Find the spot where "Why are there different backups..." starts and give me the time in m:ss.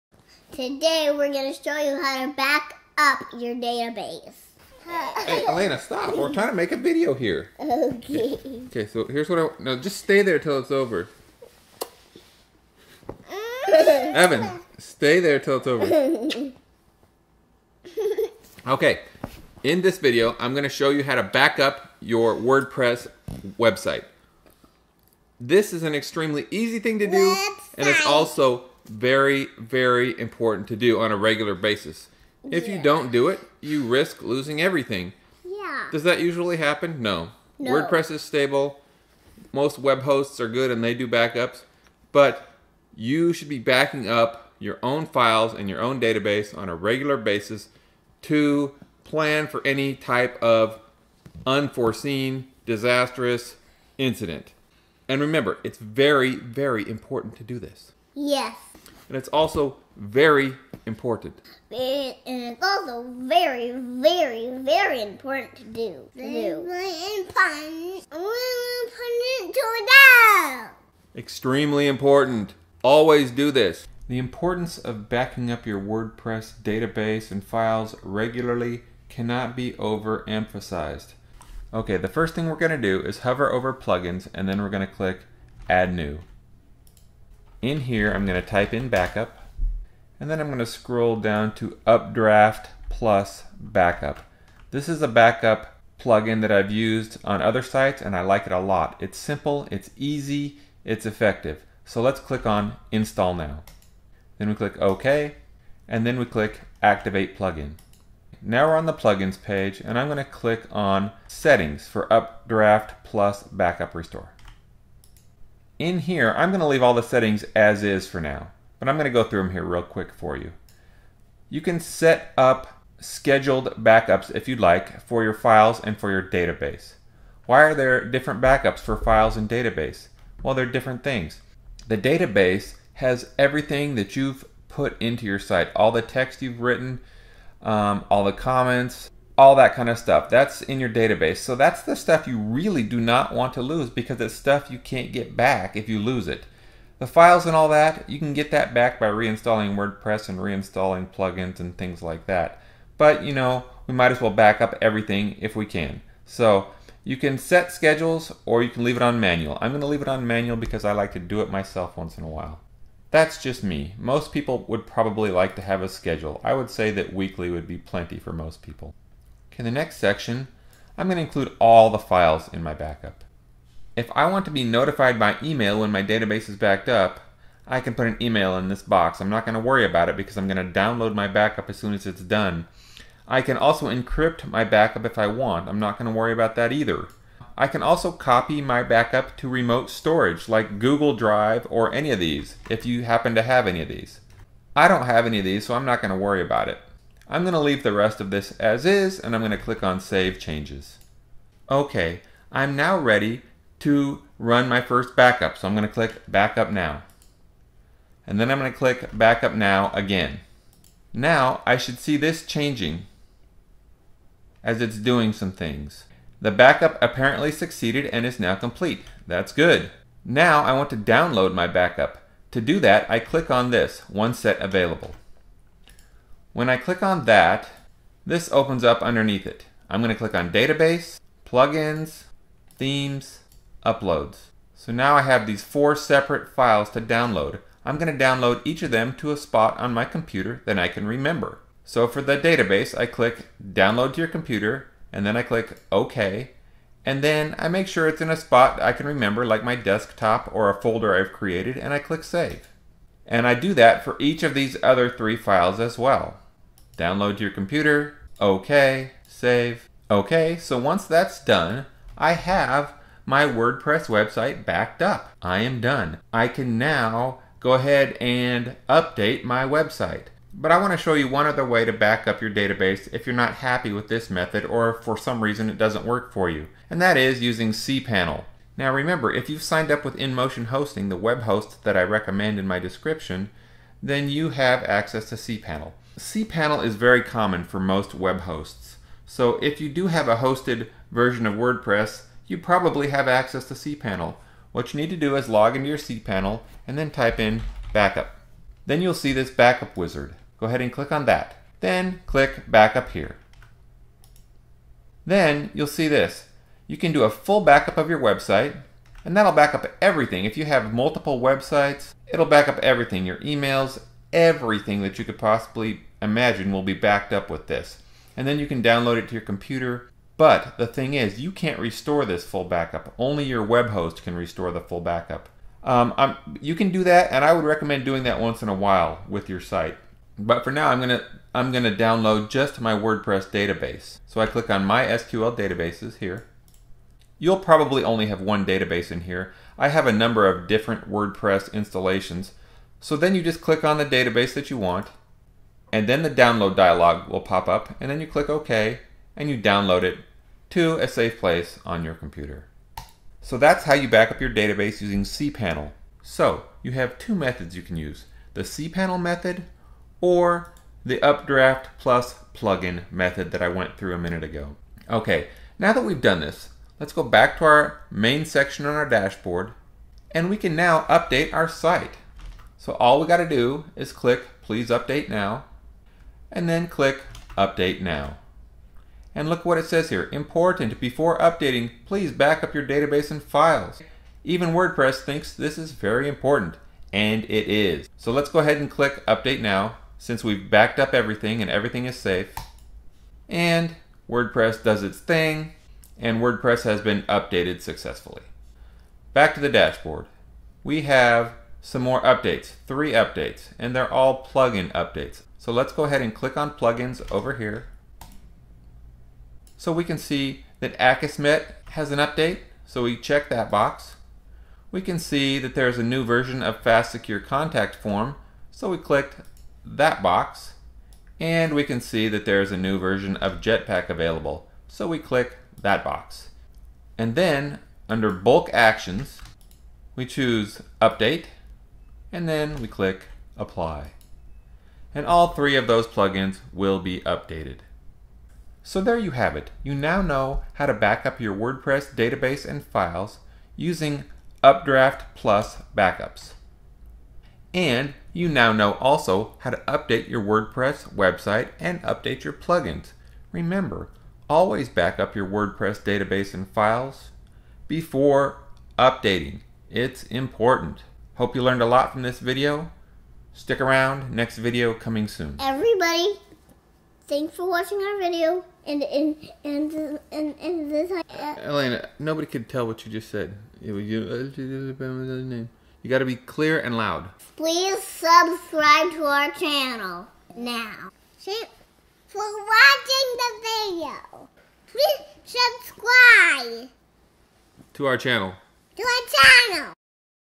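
2:07.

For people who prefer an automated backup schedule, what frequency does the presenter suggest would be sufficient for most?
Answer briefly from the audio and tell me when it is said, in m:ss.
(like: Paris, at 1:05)
Weekly, at 2:47.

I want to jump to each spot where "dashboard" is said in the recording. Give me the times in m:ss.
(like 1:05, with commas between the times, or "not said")
6:09, 6:39.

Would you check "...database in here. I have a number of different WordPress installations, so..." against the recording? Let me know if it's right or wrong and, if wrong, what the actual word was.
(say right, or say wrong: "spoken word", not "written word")
right.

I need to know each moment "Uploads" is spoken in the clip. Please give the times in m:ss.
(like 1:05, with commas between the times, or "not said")
3:53.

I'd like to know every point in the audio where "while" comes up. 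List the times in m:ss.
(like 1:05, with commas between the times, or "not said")
2:42, 5:28.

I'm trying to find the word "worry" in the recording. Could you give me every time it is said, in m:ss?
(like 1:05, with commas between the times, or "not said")
2:59, 3:06, 3:16.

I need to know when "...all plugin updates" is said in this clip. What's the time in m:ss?
6:44.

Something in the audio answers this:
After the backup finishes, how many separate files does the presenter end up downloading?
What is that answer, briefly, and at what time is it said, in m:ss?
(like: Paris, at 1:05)
4, at 3:55.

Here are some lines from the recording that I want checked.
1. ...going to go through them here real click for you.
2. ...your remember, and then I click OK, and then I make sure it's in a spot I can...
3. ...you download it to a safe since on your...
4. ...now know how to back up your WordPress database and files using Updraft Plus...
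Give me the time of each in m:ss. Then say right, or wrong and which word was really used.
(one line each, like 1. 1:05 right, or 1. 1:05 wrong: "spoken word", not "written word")
1. 1:58 wrong: "quick", not "click"
2. 4:04 wrong: "computer", not "remember"
3. 5:49 wrong: "place", not "since"
4. 7:19 right.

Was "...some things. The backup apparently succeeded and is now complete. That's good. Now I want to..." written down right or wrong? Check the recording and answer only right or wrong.
right.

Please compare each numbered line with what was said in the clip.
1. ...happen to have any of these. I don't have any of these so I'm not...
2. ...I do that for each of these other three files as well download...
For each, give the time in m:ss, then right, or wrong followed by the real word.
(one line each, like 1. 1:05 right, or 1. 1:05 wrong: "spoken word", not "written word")
1. 3:13 right
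2. 4:13 right.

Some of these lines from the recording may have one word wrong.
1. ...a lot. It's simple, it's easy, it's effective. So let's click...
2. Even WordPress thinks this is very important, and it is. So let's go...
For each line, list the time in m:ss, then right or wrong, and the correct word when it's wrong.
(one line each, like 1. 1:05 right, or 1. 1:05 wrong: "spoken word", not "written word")
1. 1:38 right
2. 6:24 right.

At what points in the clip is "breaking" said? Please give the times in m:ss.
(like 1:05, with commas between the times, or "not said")
not said.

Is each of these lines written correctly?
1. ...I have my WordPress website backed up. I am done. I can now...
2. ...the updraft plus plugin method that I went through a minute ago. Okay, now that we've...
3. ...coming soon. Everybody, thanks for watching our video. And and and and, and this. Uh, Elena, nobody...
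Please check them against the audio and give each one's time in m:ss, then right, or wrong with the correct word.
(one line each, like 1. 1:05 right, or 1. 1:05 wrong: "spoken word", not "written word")
1. 4:22 right
2. 6:01 right
3. 7:44 right.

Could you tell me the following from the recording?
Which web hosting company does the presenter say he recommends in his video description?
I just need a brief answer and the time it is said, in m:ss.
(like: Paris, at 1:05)
InMotion Hosting, at 4:40.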